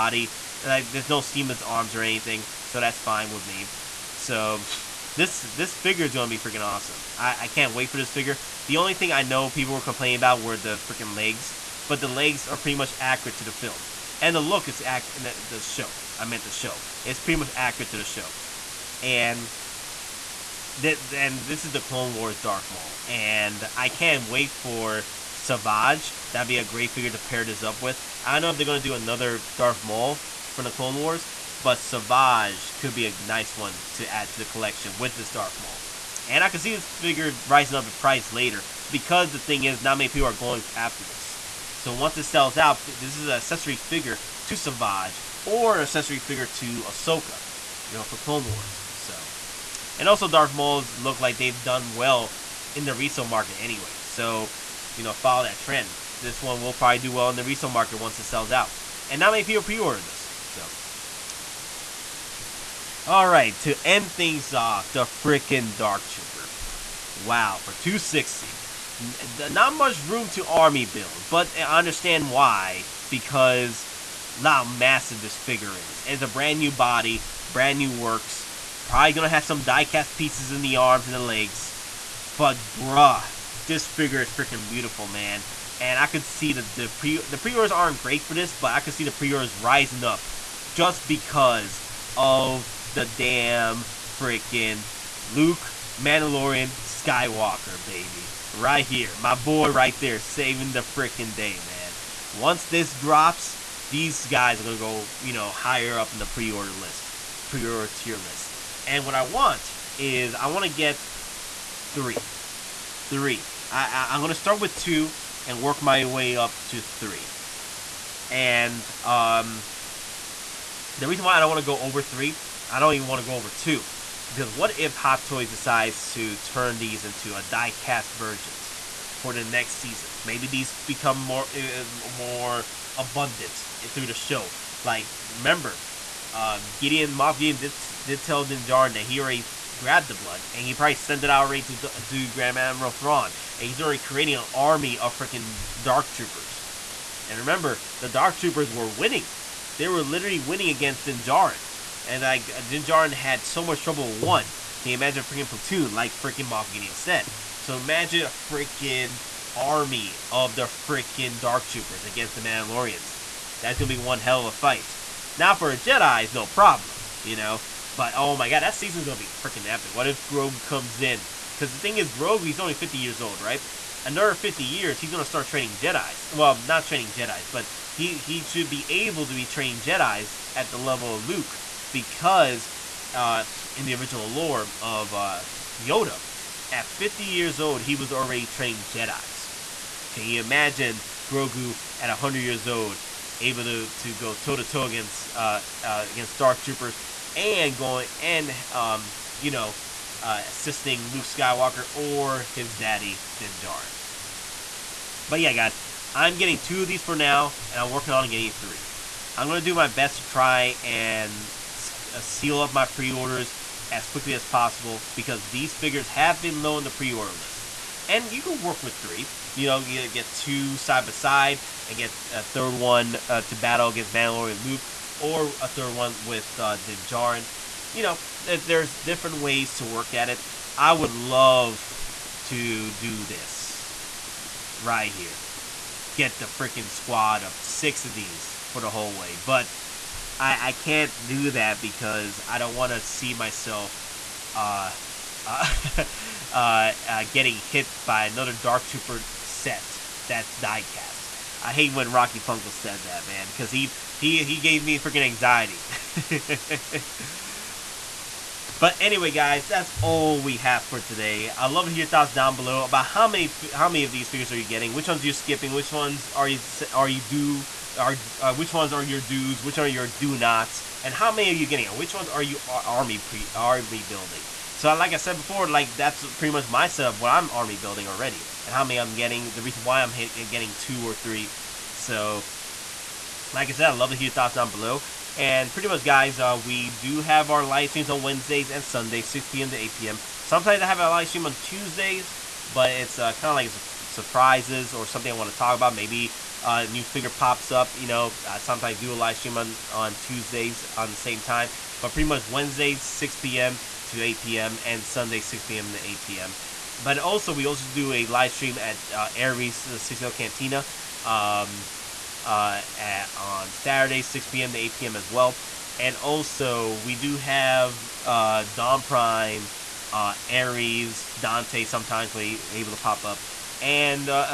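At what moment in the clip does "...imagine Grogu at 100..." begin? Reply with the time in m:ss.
3:10.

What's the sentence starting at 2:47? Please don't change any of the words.
But oh my god, that season's gonna be freaking epic.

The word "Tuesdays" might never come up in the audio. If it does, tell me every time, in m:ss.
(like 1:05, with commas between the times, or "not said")
4:51, 5:00.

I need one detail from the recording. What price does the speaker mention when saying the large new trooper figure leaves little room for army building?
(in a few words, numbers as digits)
260.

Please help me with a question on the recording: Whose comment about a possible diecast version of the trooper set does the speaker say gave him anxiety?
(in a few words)
Rocky Funkle.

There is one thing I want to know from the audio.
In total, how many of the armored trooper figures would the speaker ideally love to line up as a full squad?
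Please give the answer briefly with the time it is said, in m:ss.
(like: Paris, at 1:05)
6, at 3:57.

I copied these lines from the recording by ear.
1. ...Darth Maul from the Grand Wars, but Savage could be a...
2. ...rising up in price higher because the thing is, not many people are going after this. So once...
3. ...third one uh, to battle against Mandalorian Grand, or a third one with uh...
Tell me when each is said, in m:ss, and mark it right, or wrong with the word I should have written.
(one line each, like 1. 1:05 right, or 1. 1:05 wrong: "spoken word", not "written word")
1. 0:29 wrong: "Clone", not "Grand"
2. 0:37 wrong: "later", not "higher"
3. 3:42 wrong: "Luke", not "Grand".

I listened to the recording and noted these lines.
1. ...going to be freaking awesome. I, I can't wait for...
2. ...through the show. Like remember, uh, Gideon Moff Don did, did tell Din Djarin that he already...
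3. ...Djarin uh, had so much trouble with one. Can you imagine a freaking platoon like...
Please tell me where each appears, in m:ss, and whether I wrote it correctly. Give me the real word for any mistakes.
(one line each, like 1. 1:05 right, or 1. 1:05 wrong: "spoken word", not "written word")
1. 0:06 right
2. 2:13 wrong: "Gideon", not "Don"
3. 2:32 right.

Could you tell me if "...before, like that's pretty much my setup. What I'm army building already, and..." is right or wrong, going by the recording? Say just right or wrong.
right.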